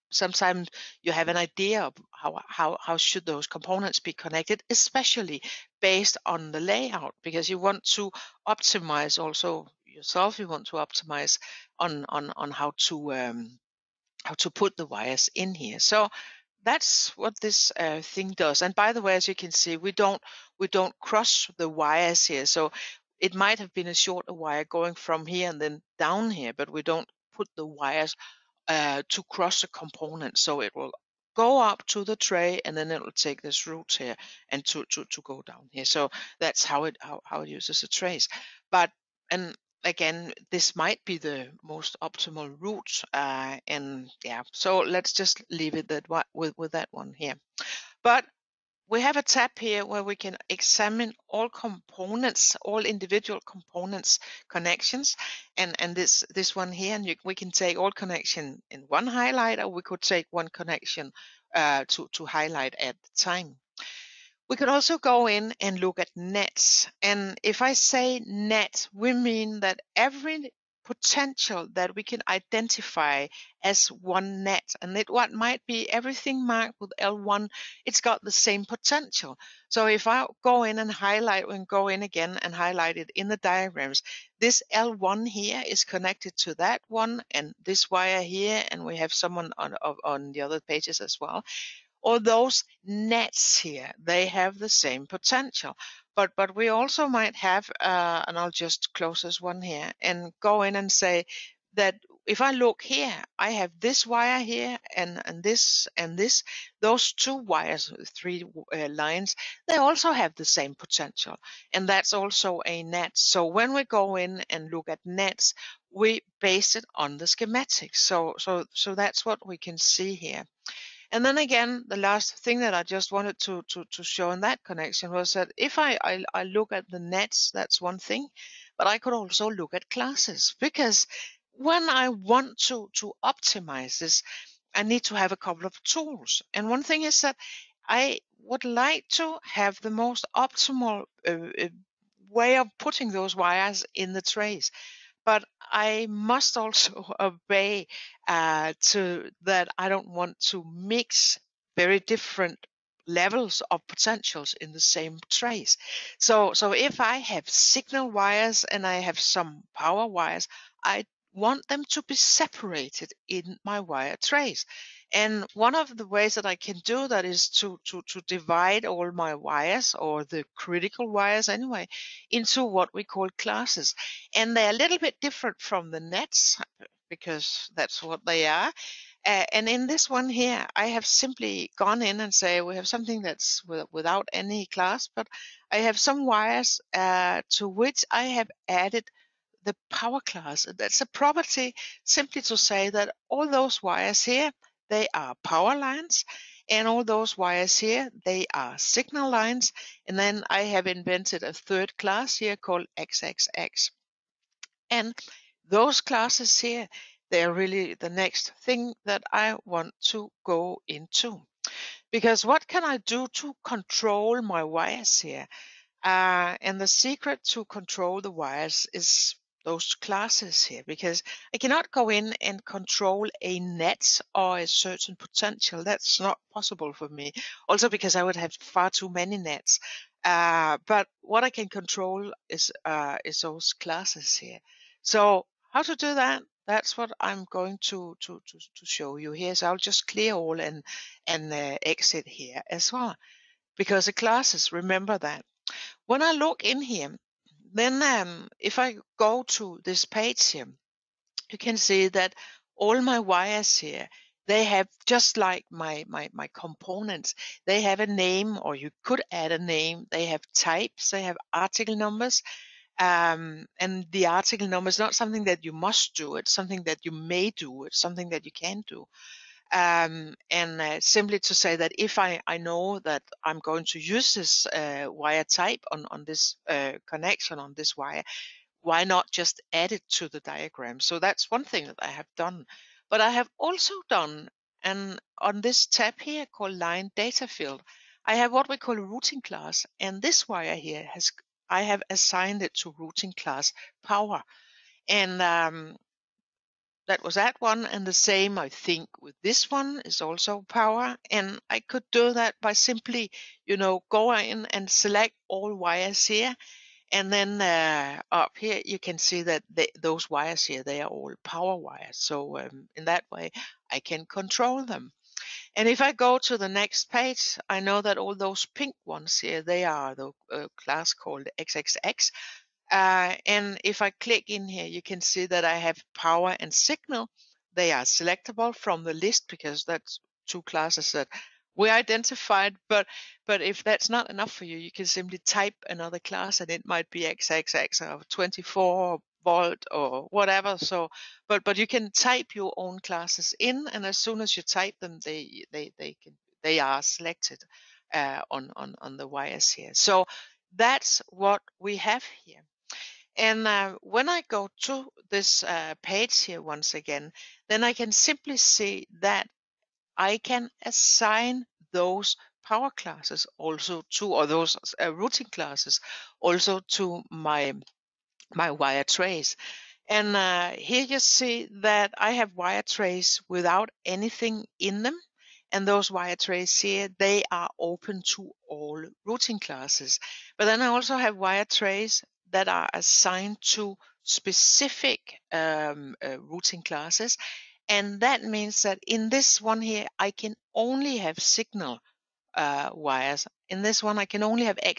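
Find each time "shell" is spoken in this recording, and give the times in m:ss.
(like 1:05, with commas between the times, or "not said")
not said.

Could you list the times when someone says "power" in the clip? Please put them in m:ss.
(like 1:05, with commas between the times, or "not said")
2:39, 3:09, 3:15, 4:54, 5:00, 5:11, 5:26, 6:02.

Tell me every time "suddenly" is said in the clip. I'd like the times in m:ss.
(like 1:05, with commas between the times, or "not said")
not said.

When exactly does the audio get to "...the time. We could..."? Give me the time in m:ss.
1:03.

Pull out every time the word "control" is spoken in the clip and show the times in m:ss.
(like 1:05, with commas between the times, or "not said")
3:33, 3:37, 3:42, 3:51, 5:14.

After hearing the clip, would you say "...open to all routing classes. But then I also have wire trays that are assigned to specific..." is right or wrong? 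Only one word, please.
right.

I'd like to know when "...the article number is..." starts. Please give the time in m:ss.
4:24.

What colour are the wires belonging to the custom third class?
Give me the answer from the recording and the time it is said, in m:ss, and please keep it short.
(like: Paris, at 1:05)
Pink, at 5:18.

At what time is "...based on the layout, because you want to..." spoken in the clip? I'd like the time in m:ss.
0:05.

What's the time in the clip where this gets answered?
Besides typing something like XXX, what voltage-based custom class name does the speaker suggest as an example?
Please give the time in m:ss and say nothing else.
5:38.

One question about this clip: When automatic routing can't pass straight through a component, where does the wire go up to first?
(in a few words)
The tray.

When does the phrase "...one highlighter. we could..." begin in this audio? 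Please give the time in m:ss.
0:58.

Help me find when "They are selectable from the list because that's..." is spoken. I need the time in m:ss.
5:27.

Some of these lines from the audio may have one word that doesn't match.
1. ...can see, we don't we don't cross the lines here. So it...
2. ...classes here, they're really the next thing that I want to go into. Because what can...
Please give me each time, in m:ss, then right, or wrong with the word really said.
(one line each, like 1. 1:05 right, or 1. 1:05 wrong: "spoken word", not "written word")
1. 0:19 wrong: "wires", not "lines"
2. 3:26 right.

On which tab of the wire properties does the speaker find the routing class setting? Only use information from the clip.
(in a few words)
Line data field.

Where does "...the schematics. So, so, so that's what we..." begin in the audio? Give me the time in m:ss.
1:57.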